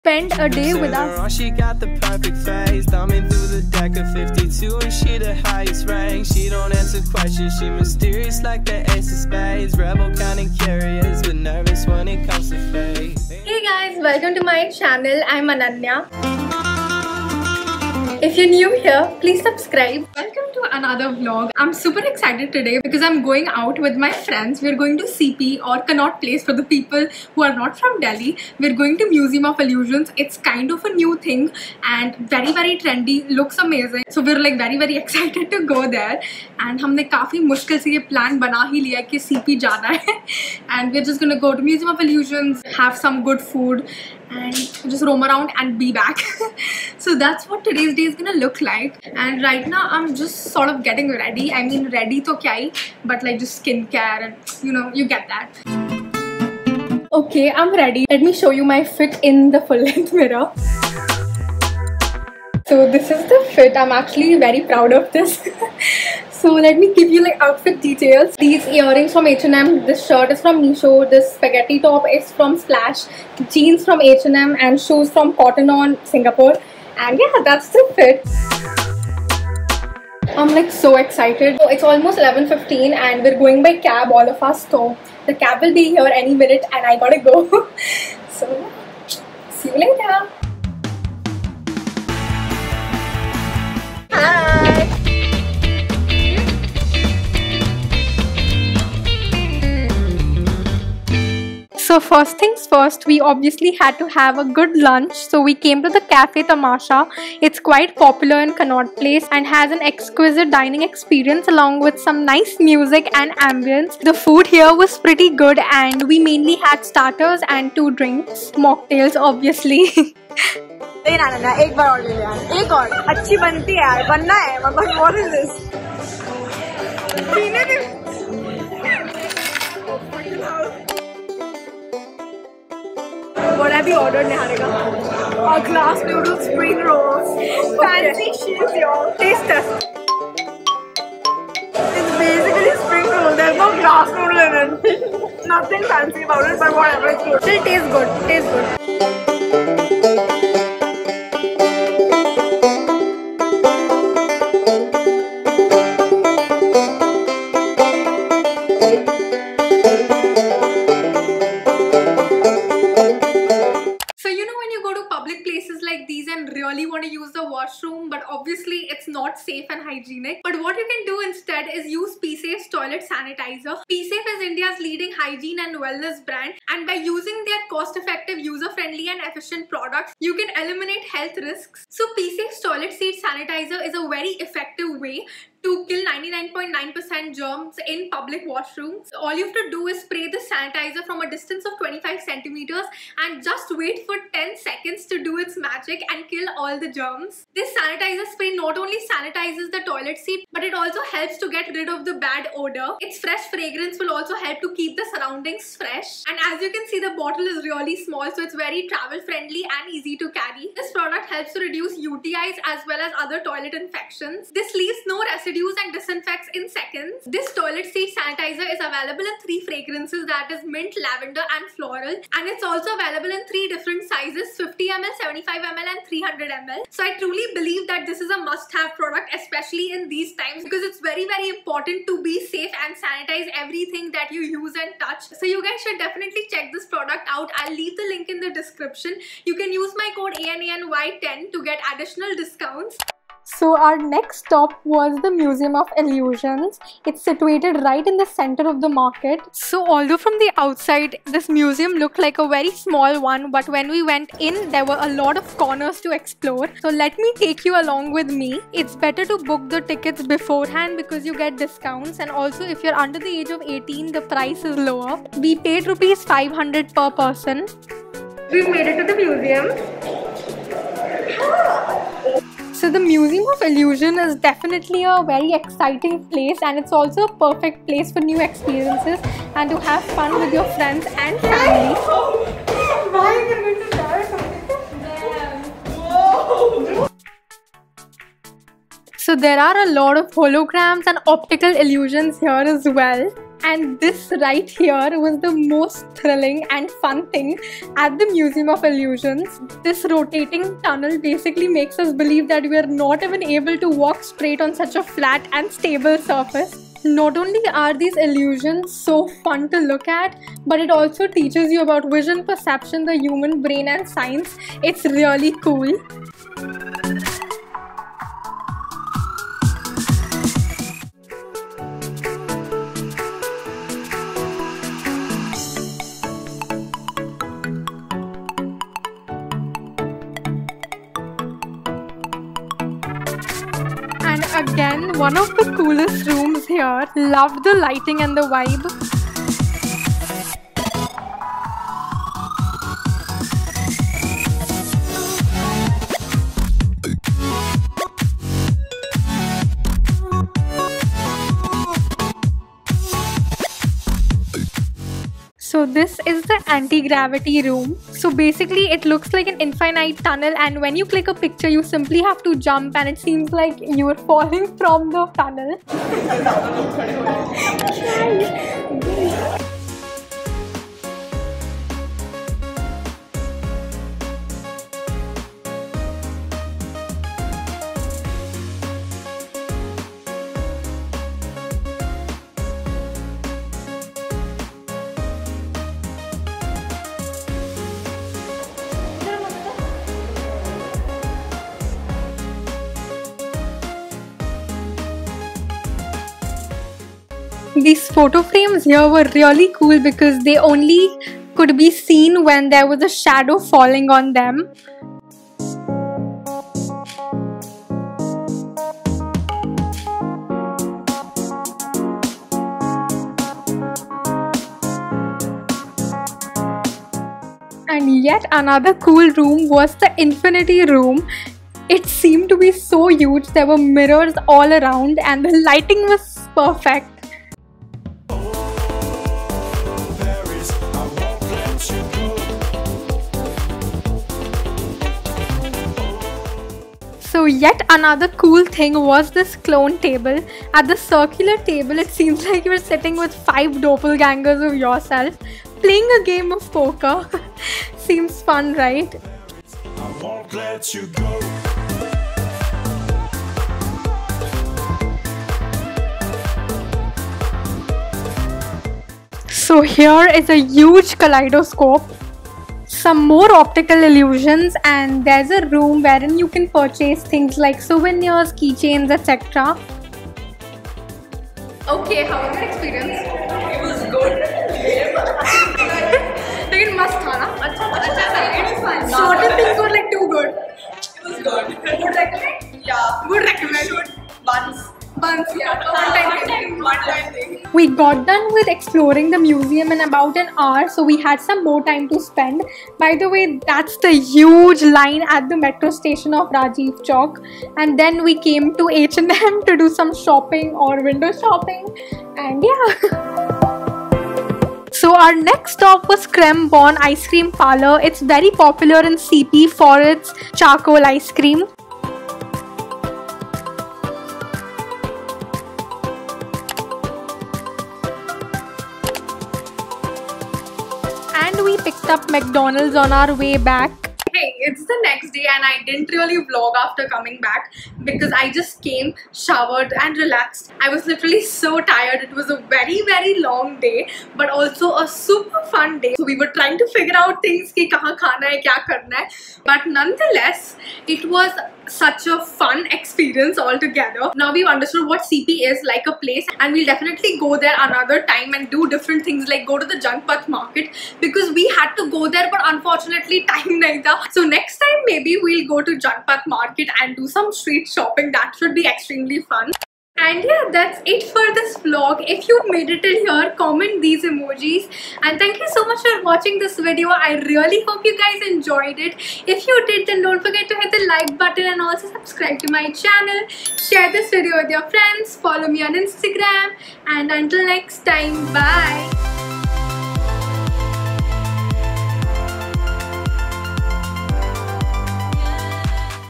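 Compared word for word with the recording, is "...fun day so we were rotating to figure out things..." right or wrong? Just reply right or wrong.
wrong.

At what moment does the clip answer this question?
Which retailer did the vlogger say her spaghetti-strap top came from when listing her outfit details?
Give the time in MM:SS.
01:12.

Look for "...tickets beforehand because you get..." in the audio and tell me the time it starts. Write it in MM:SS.
04:19.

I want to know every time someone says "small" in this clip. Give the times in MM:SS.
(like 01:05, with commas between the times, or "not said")
03:27, 04:12.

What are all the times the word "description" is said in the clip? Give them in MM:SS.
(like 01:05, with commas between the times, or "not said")
03:58.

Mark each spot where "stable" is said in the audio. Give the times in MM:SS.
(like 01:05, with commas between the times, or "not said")
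05:05.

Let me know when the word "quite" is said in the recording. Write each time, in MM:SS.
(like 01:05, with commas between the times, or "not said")
01:47.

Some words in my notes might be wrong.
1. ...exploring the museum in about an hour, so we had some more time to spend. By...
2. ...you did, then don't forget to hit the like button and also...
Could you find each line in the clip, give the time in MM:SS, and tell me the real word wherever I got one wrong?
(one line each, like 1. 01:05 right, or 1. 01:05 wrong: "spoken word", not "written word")
1. 08:08 right
2. 09:29 right.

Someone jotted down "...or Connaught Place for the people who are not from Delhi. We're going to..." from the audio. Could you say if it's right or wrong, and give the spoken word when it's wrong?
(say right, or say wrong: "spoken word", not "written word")
right.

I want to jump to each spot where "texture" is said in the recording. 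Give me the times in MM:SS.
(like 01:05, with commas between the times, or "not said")
not said.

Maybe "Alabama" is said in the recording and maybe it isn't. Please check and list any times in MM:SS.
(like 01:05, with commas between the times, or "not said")
not said.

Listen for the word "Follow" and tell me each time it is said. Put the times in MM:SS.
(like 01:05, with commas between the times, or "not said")
09:35.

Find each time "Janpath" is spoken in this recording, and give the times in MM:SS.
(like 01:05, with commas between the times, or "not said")
09:10, 09:15.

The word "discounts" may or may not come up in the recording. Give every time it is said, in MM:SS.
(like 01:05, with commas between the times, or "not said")
04:02, 04:21.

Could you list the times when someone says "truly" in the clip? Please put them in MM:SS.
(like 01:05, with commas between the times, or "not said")
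03:47.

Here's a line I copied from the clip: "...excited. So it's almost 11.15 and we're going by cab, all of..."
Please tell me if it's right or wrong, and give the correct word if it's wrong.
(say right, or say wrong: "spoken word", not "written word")
right.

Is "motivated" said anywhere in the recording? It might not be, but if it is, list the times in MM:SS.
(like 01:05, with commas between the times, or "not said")
not said.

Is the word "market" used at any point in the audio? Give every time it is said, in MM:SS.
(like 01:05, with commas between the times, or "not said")
04:08, 09:10, 09:16.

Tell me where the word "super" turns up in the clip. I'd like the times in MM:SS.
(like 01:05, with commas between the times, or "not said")
00:21, 08:55.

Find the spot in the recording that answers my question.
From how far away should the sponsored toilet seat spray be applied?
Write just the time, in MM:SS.
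03:11.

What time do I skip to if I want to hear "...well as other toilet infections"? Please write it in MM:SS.
03:32.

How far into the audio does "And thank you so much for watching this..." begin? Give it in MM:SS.
09:25.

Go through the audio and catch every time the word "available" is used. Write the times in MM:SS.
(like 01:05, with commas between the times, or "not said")
03:38, 03:42.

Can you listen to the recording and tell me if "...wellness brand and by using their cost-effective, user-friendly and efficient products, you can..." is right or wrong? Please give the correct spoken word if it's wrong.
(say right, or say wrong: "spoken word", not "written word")
right.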